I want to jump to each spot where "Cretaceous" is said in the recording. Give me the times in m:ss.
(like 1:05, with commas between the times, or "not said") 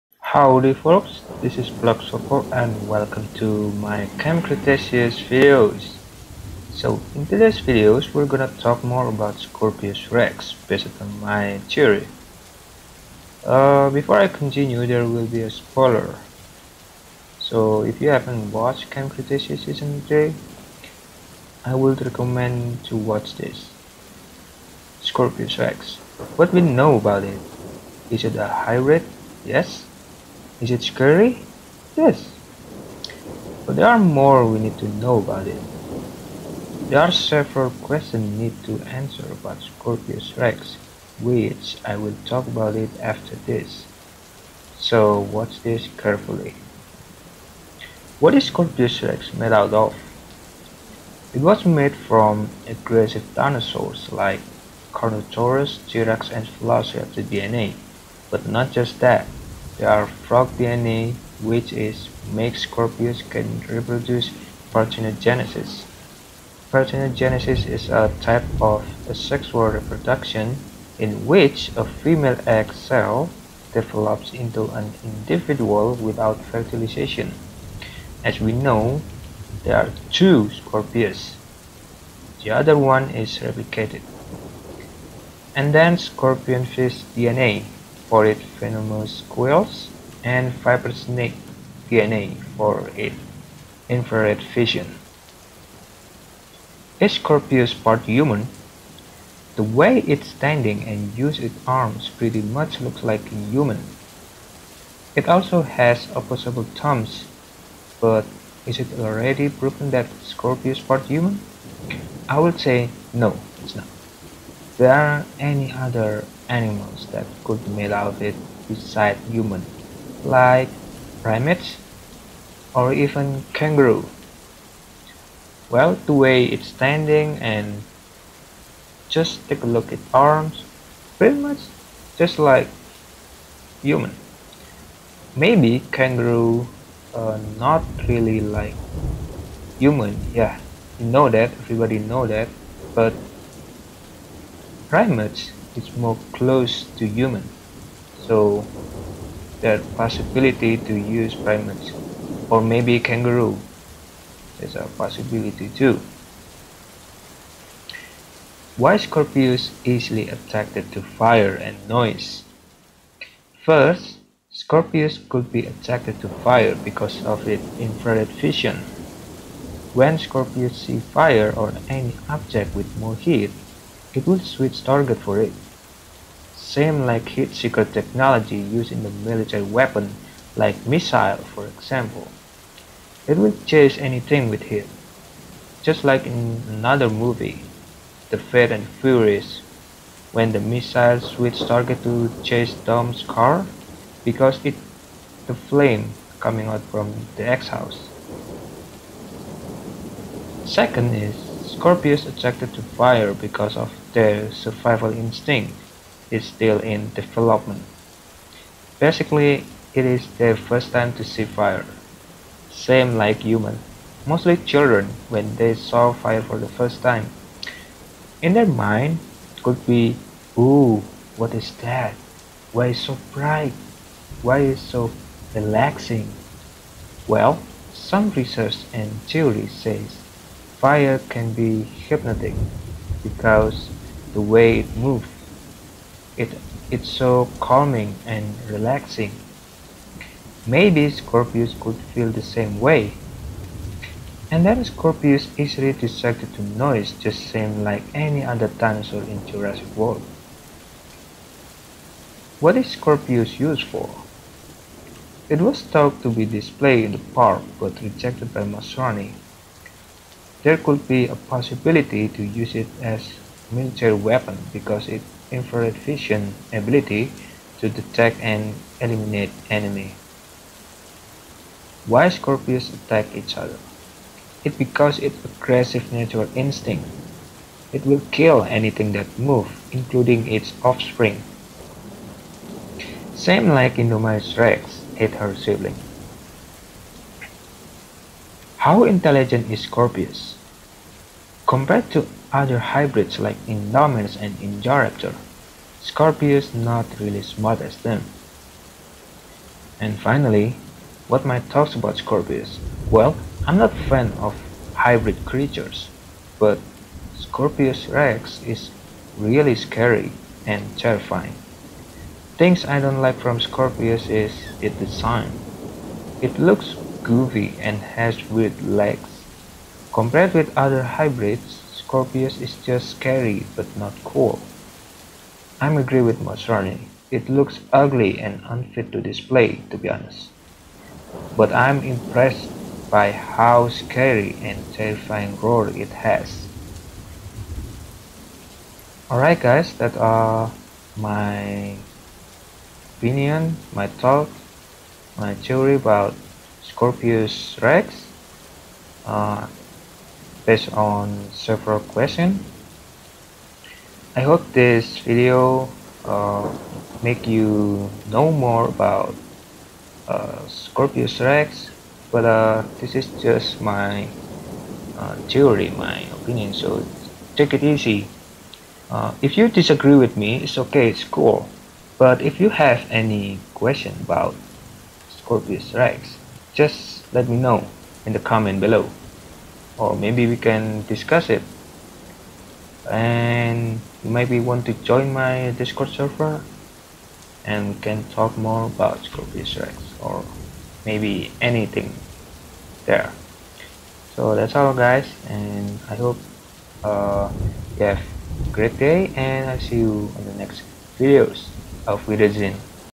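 0:04, 0:19.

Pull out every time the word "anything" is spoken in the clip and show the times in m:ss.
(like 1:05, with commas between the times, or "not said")
3:03, 4:38, 6:31.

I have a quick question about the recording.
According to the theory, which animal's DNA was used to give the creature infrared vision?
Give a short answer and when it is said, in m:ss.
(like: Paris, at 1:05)
Snake, at 1:30.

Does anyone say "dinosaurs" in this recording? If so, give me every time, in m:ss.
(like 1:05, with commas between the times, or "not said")
0:53, 4:08.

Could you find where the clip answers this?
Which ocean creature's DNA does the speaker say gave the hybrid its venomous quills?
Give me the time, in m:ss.
1:25.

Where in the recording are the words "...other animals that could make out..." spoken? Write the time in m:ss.
1:55.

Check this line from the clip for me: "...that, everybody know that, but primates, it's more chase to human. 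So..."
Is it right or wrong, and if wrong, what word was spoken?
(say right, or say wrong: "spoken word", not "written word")
wrong: "close", not "chase".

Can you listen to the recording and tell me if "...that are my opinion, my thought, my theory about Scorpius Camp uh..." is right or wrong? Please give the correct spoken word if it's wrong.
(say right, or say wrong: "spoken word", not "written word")
wrong: "Rex", not "Camp".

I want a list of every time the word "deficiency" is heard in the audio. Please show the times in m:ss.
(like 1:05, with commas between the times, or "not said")
not said.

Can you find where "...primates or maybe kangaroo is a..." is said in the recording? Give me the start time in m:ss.
2:31.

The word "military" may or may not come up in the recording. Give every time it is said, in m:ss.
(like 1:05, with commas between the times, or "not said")
2:59, 4:23.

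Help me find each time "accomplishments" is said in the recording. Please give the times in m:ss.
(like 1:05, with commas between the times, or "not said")
not said.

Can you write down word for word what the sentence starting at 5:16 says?
It looks groovy and has weird legs.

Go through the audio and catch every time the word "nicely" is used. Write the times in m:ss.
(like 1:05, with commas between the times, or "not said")
not said.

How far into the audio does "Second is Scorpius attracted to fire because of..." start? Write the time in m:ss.
3:20.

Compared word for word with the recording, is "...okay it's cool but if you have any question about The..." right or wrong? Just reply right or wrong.
wrong.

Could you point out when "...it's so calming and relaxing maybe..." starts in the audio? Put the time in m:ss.
3:56.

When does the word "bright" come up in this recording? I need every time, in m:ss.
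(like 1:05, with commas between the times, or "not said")
3:43.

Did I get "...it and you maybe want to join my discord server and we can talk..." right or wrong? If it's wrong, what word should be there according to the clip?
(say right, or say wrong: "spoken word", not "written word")
right.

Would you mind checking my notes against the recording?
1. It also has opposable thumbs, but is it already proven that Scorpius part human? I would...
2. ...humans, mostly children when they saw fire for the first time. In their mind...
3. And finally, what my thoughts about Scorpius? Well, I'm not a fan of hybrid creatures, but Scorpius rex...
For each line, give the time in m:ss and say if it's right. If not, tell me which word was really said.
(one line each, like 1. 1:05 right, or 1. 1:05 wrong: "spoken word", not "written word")
1. 1:45 right
2. 3:33 right
3. 4:59 right.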